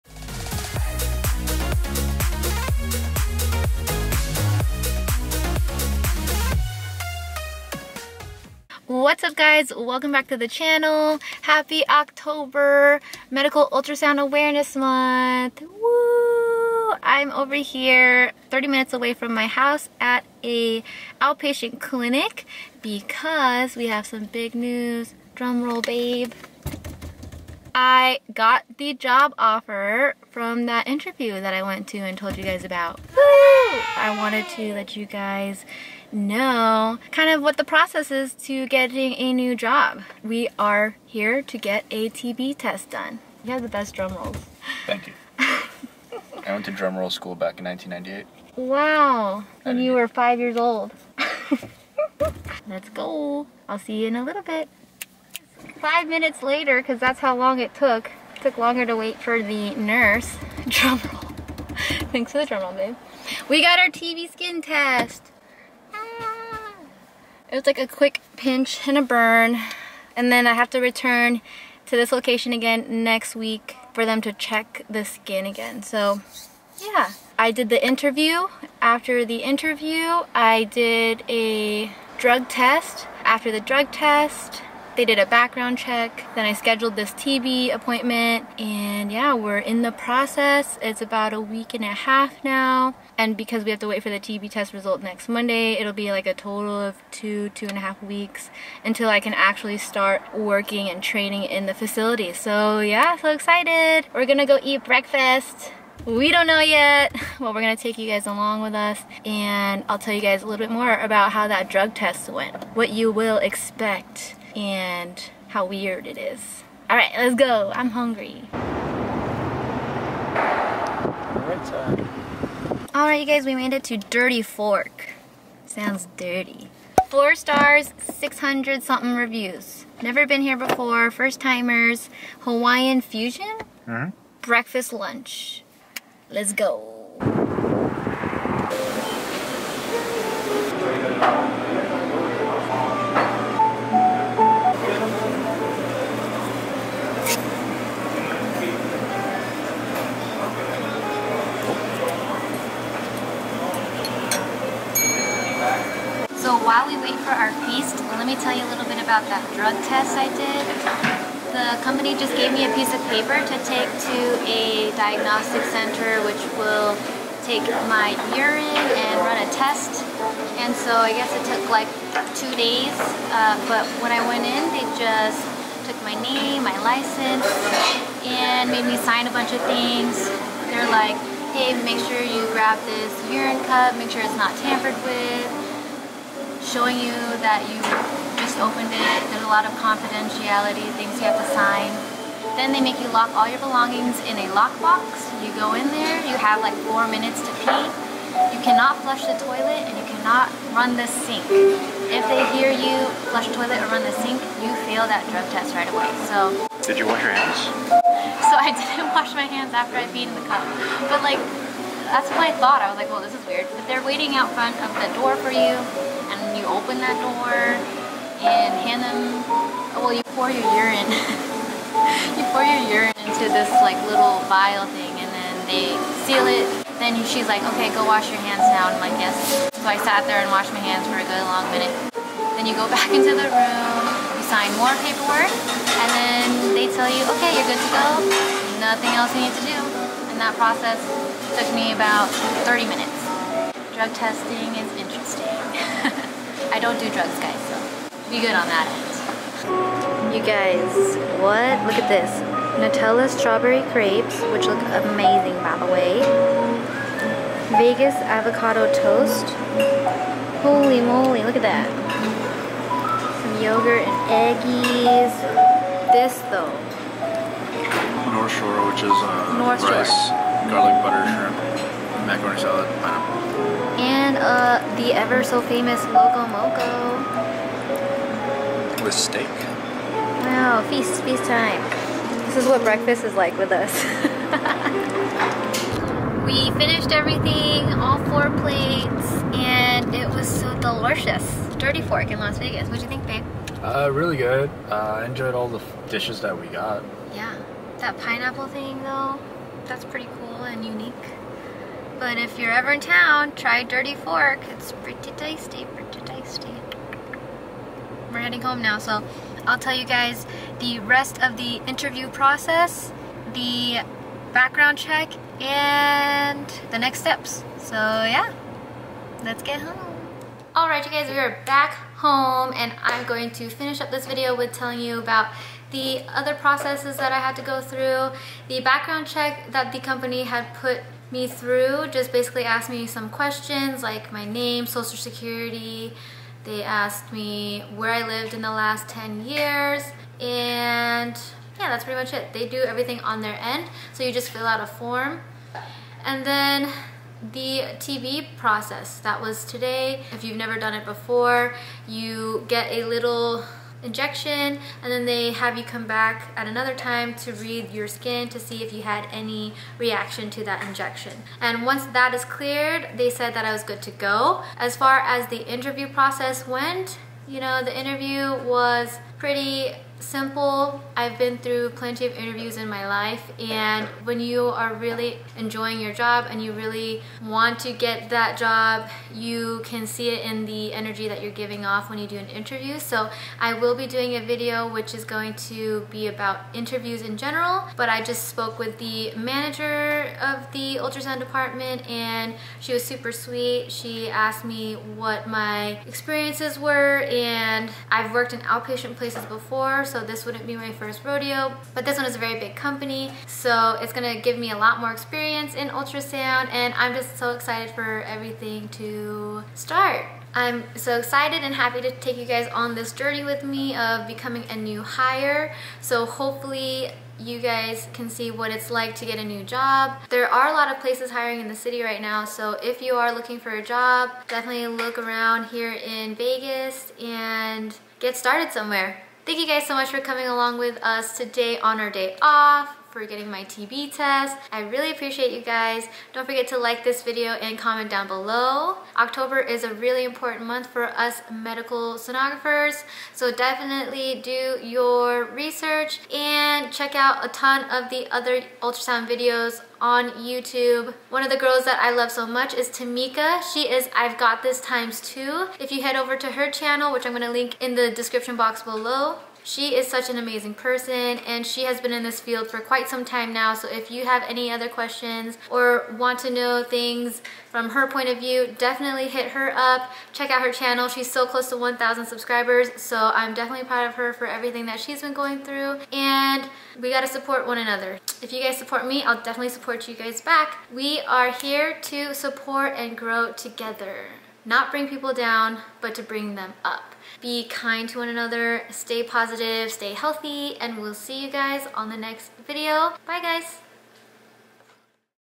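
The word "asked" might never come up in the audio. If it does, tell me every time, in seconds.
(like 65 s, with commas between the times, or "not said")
332 s, 336 s, 394 s.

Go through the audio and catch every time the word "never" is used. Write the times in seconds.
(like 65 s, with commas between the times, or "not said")
130 s, 350 s.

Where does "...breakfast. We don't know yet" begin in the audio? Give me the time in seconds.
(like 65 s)
104 s.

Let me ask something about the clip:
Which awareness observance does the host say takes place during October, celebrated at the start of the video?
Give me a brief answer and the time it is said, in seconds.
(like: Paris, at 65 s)
Medical Ultrasound Awareness Month, at 13 s.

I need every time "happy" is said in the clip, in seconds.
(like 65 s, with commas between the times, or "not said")
11 s, 411 s.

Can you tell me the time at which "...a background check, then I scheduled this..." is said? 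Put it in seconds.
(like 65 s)
85 s.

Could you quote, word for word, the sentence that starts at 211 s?
But like that's what I thought.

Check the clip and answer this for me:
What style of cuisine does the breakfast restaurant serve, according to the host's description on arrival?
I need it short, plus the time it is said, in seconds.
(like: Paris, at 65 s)
Hawaiian fusion, at 132 s.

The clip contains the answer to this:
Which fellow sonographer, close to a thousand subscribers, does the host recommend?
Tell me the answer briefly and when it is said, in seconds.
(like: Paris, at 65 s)
Tamika, at 452 s.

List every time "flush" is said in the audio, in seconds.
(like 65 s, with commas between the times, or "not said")
199 s, 203 s.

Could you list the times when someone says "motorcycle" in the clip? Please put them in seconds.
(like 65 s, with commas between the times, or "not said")
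not said.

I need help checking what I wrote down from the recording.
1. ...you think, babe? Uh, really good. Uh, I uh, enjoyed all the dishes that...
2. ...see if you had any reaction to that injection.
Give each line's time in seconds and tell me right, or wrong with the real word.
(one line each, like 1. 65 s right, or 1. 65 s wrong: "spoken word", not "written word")
1. 293 s right
2. 358 s right.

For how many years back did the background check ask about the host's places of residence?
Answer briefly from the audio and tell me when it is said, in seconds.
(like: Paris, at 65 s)
10 years, at 339 s.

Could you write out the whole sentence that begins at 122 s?
All right, you guys, we made it to Dirty Fork.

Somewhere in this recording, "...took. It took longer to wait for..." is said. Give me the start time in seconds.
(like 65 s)
57 s.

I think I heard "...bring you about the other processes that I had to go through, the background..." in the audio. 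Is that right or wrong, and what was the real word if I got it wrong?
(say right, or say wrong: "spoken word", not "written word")
wrong: "telling", not "bring".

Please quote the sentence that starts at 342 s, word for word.
They do everything on their end.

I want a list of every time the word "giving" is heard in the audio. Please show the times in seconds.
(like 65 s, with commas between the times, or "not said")
381 s.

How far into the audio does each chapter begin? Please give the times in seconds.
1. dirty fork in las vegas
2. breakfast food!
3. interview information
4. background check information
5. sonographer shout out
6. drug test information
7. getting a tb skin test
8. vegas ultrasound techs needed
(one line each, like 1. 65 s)
1. 123 s
2. 249 s
3. 366 s
4. 327 s
5. 451 s
6. 156 s
7. 54 s
8. 420 s.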